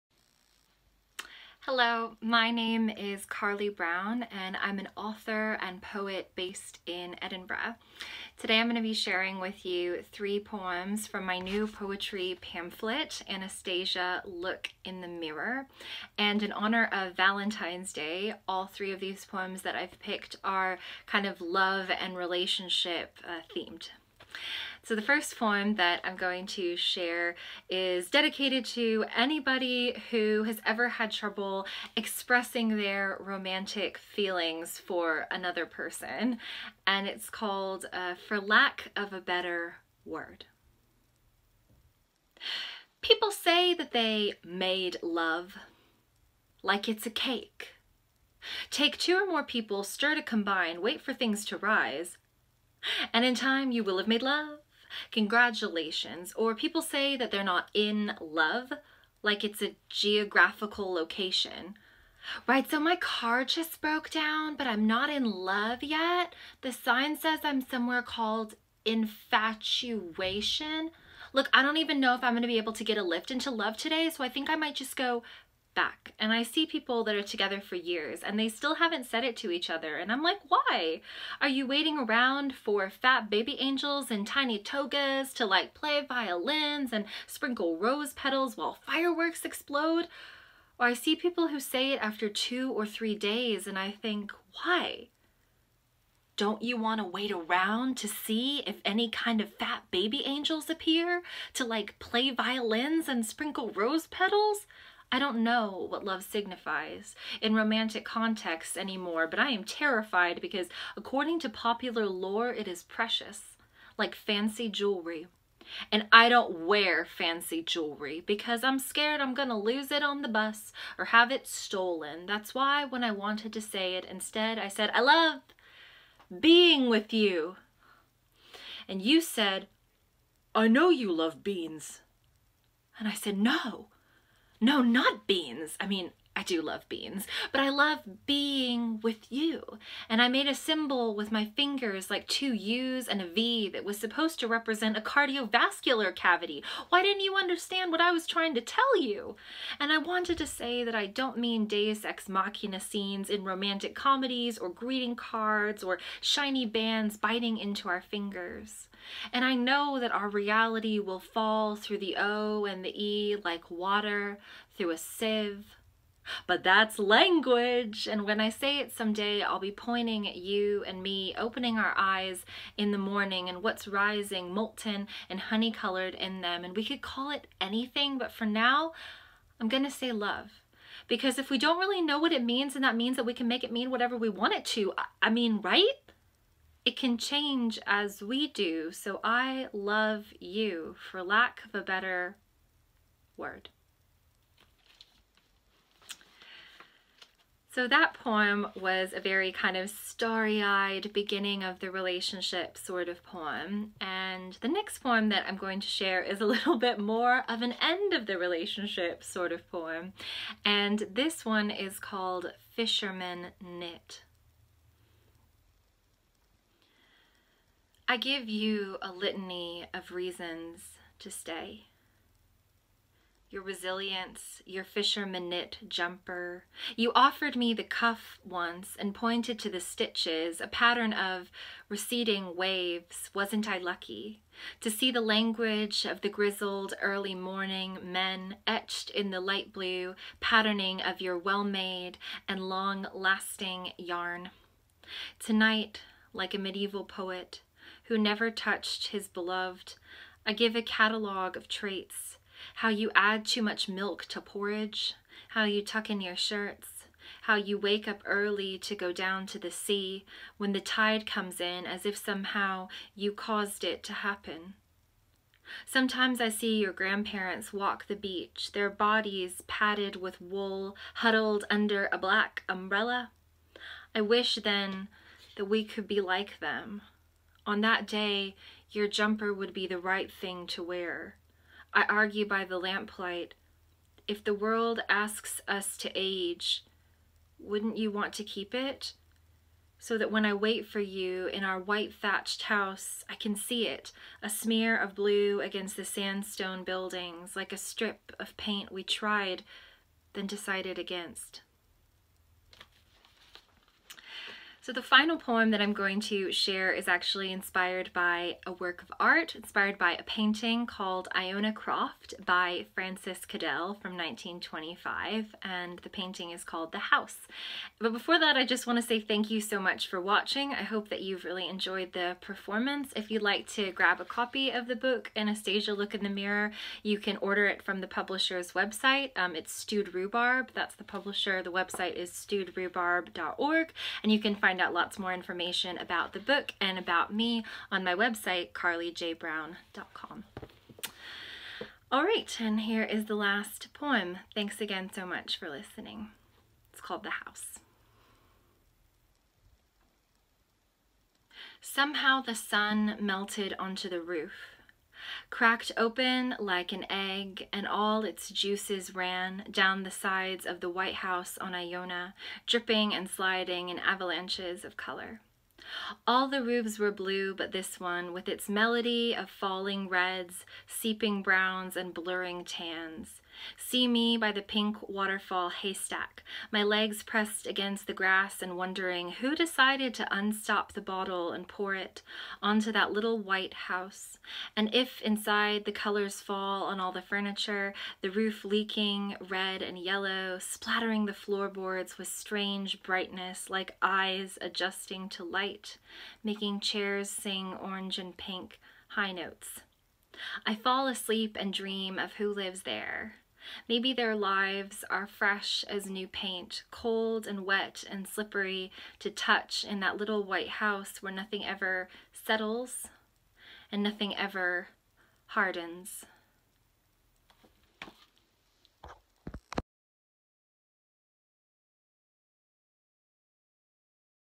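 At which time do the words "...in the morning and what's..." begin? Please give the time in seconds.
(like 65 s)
172 s.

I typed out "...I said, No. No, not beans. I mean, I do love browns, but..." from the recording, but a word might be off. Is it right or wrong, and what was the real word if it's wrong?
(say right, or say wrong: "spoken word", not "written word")
wrong: "beans", not "browns".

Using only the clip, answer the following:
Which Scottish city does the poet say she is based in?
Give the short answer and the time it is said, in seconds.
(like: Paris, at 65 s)
Edinburgh, at 7 s.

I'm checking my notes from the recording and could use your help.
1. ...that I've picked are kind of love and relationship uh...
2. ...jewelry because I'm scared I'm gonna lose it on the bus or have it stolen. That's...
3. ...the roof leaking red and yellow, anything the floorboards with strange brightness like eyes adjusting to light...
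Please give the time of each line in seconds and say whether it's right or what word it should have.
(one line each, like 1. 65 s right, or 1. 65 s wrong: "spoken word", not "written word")
1. 19 s right
2. 117 s right
3. 388 s wrong: "splattering", not "anything".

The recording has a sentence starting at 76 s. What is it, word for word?
And I see people that are together for years and they still haven't said it to each other.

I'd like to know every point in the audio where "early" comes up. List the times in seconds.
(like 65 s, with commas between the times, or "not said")
237 s, 258 s.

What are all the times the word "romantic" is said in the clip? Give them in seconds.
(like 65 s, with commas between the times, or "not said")
33 s, 107 s, 153 s.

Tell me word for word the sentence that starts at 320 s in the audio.
I hope that you've really enjoyed the performance.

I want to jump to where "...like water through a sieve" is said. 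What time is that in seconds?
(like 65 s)
163 s.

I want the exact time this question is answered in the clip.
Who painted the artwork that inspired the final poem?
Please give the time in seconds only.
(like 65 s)
312 s.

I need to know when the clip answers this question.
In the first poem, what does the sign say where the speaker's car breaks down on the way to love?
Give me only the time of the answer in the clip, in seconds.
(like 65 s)
68 s.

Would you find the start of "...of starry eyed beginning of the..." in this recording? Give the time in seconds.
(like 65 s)
199 s.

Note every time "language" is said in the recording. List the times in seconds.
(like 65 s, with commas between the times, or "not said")
166 s, 235 s.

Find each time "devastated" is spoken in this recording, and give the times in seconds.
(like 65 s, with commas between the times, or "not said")
not said.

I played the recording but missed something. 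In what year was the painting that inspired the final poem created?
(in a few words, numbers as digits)
1925.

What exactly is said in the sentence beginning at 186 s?
It can change as we do, so I love you, for lack of a better word.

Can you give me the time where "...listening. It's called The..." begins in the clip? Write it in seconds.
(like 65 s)
345 s.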